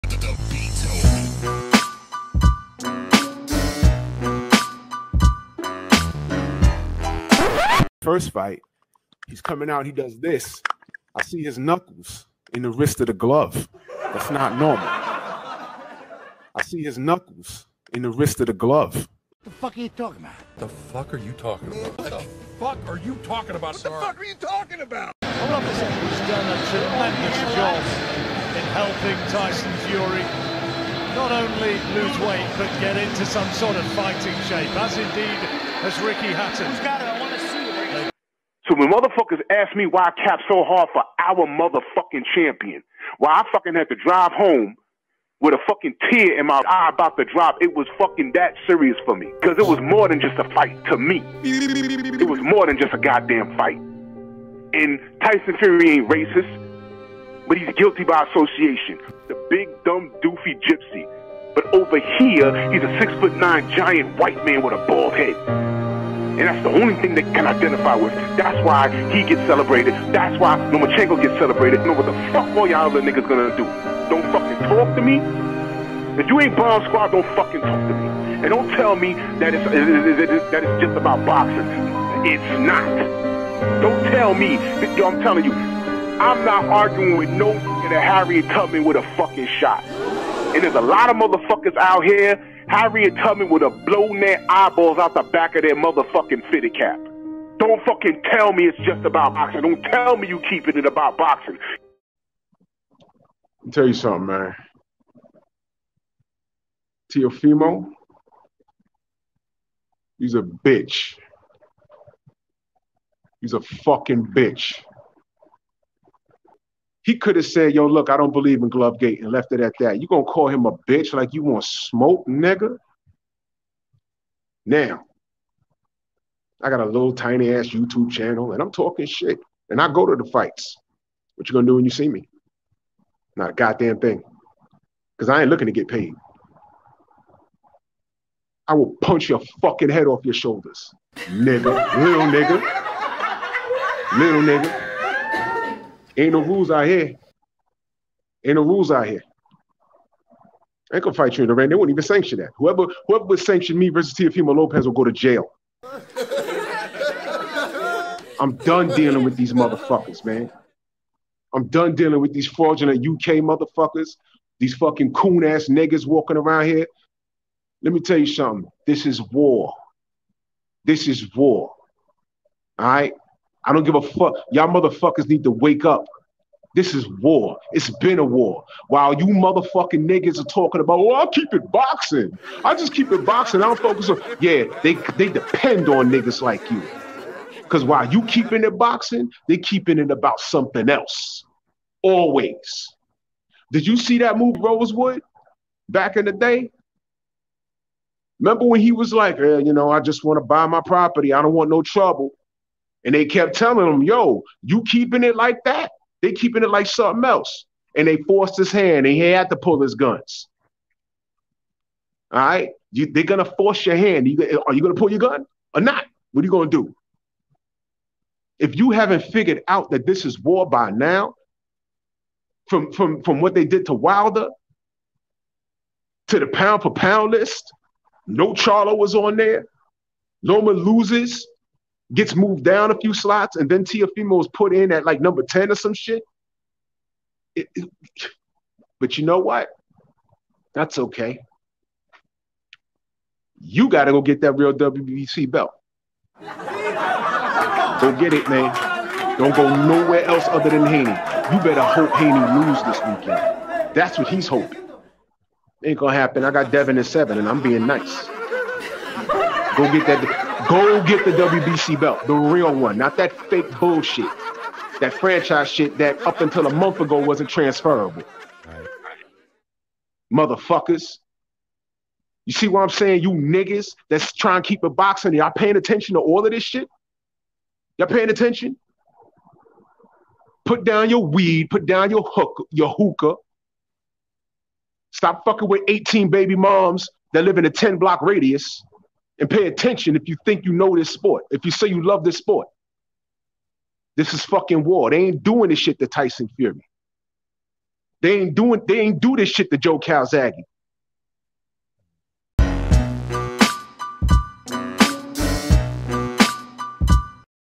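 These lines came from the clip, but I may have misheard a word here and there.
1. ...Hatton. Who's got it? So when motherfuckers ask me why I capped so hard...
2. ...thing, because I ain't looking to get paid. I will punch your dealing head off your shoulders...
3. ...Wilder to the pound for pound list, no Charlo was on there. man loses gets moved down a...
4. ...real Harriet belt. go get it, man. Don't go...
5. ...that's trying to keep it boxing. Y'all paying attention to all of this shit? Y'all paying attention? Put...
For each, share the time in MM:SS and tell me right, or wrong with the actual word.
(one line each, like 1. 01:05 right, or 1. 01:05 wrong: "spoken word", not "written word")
1. 00:36 right
2. 02:13 wrong: "fucking", not "dealing"
3. 03:43 right
4. 04:04 wrong: "WBC", not "Harriet"
5. 04:34 right.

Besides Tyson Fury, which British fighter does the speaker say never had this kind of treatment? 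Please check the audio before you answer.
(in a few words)
Joe Calzaghe.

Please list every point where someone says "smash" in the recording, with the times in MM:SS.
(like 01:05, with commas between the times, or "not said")
not said.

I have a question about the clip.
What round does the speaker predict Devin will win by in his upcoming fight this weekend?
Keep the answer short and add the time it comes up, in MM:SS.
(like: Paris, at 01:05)
7, at 04:17.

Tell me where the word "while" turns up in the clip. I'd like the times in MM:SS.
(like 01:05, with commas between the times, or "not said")
02:58, 03:07.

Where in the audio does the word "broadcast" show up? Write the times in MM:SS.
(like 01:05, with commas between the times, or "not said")
not said.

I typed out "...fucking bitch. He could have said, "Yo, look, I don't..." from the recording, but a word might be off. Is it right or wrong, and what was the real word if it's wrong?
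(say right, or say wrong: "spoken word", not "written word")
right.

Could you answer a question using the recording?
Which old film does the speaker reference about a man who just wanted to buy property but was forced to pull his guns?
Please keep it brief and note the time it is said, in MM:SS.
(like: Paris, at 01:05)
Rosewood, at 03:14.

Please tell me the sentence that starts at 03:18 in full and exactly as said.
Remember when he was like, eh, you know, I just want to buy my property.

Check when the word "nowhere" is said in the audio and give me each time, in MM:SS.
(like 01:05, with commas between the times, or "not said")
04:09.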